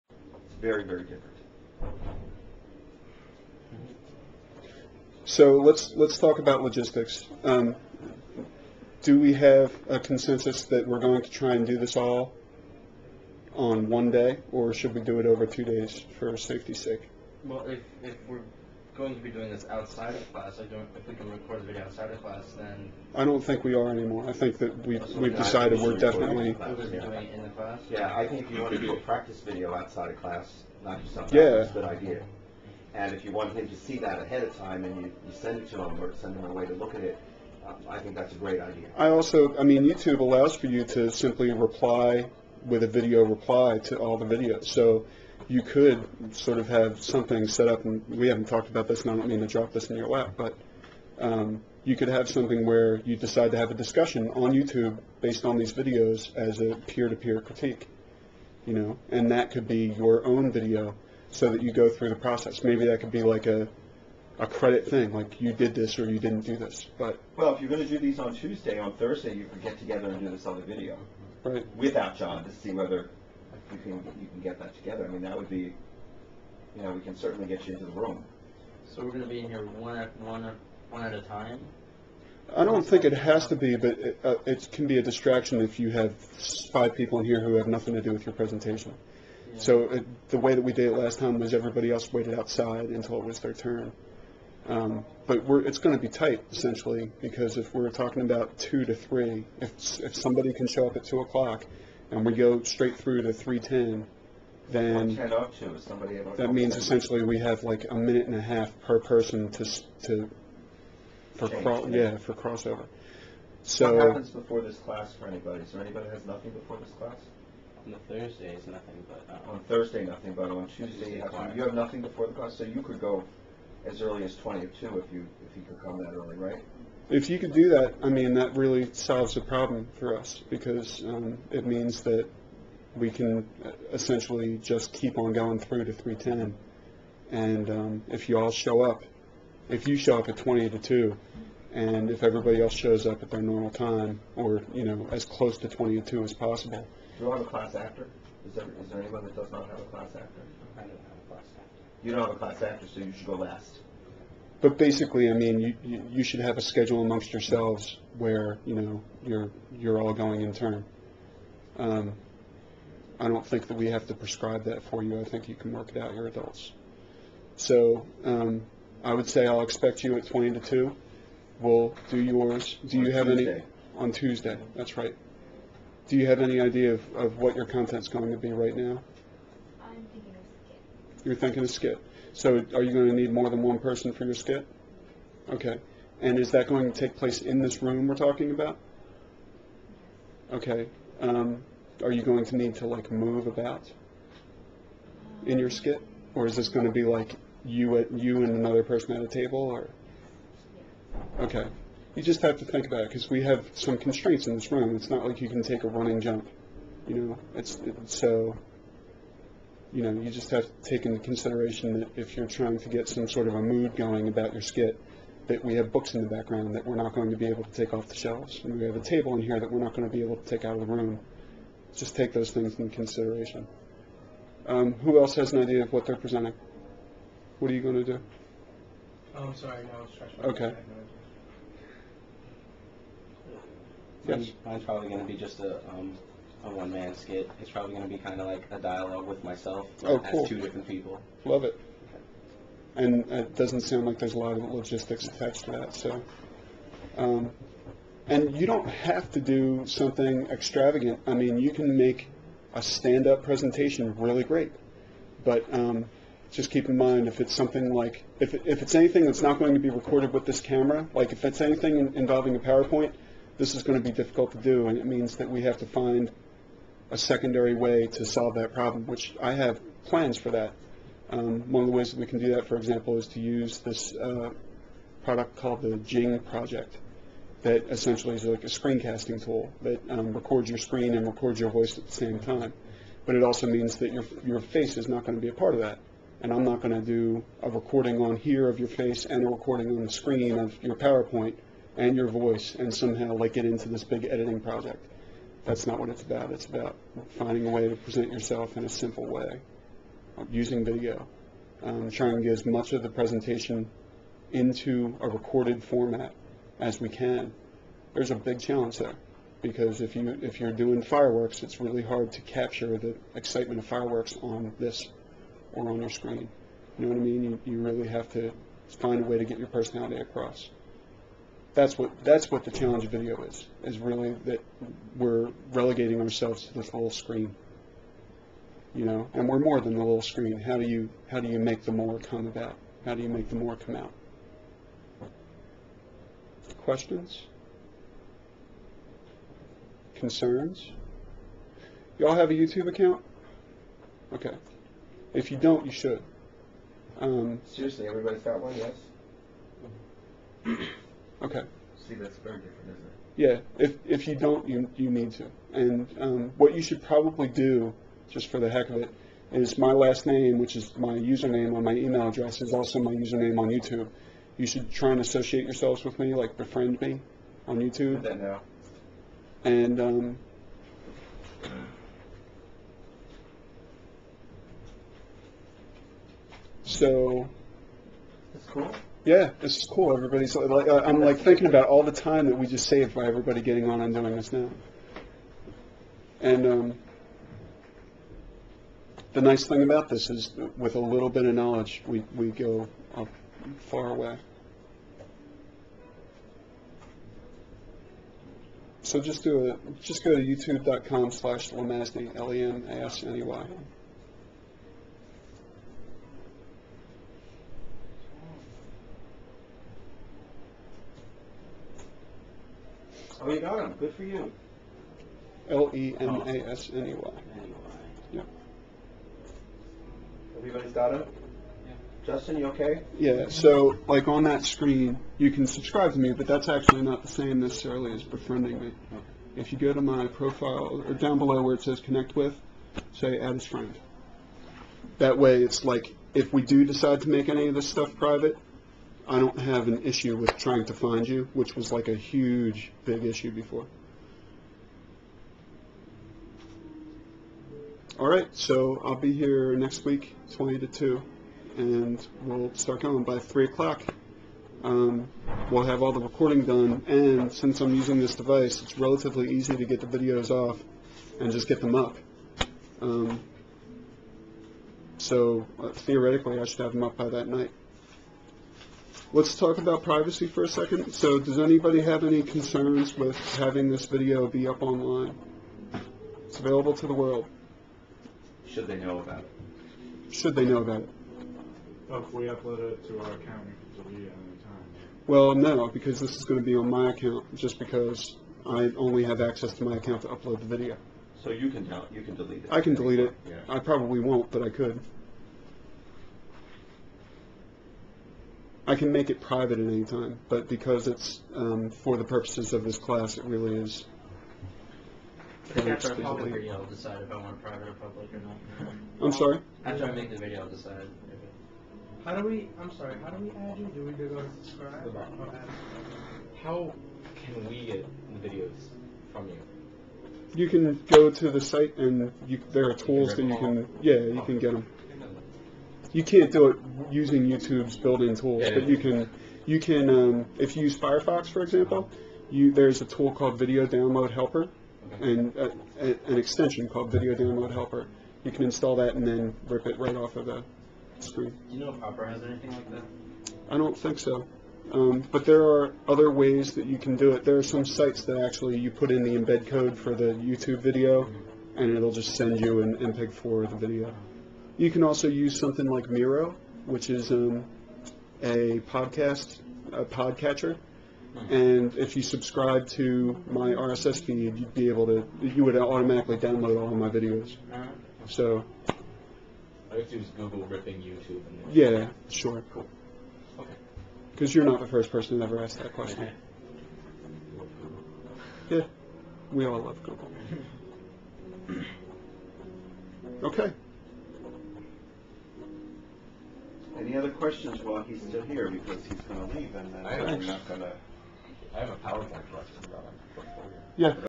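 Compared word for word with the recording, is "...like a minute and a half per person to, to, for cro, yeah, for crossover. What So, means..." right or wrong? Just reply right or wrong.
wrong.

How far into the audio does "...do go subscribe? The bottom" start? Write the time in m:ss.
8:34.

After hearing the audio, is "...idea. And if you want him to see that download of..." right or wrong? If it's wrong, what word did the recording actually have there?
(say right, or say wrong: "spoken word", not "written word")
wrong: "ahead", not "download".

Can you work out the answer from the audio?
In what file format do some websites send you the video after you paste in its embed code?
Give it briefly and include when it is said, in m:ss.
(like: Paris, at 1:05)
MPEG-4, at 9:12.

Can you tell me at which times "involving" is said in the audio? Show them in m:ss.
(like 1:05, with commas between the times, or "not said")
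4:22.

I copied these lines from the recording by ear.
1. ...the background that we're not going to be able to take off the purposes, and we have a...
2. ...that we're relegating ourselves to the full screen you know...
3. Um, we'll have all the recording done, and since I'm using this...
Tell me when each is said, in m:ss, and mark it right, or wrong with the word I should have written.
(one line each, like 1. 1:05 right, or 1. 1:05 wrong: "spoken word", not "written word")
1. 3:36 wrong: "shelves", not "purposes"
2. 5:24 right
3. 7:34 right.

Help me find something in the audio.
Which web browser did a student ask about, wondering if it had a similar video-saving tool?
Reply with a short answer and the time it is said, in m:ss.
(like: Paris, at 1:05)
Opera, at 9:02.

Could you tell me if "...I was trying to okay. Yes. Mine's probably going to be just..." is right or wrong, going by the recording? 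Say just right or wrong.
right.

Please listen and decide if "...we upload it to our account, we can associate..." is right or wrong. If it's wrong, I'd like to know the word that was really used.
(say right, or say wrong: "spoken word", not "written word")
wrong: "delete", not "associate".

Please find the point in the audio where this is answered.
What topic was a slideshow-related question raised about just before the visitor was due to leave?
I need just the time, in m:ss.
9:53.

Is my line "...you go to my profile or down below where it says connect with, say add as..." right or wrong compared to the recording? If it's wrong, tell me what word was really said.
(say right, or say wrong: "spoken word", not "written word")
right.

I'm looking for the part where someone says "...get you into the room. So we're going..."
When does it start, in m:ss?
1:17.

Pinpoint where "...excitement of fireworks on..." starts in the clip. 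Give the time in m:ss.
5:13.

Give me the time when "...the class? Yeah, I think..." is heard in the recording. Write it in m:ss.
0:27.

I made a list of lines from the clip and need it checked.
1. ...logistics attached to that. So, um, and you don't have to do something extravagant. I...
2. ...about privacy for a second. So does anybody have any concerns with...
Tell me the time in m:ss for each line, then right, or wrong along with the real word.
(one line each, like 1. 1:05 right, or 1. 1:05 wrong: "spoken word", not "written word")
1. 4:04 right
2. 7:49 right.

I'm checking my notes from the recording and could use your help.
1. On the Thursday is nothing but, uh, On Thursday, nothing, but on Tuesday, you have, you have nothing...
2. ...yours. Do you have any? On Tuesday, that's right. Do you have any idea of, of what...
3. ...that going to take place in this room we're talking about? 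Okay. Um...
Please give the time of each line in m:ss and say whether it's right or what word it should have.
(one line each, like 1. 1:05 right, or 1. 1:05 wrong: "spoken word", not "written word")
1. 1:57 right
2. 2:52 right
3. 3:06 right.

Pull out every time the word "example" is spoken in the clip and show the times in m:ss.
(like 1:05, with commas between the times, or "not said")
4:32, 8:51.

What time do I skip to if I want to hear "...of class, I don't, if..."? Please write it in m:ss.
0:20.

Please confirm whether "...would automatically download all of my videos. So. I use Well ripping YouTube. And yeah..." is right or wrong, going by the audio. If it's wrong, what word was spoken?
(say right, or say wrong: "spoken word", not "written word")
wrong: "Google", not "Well".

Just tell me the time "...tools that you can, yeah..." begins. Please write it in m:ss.
8:42.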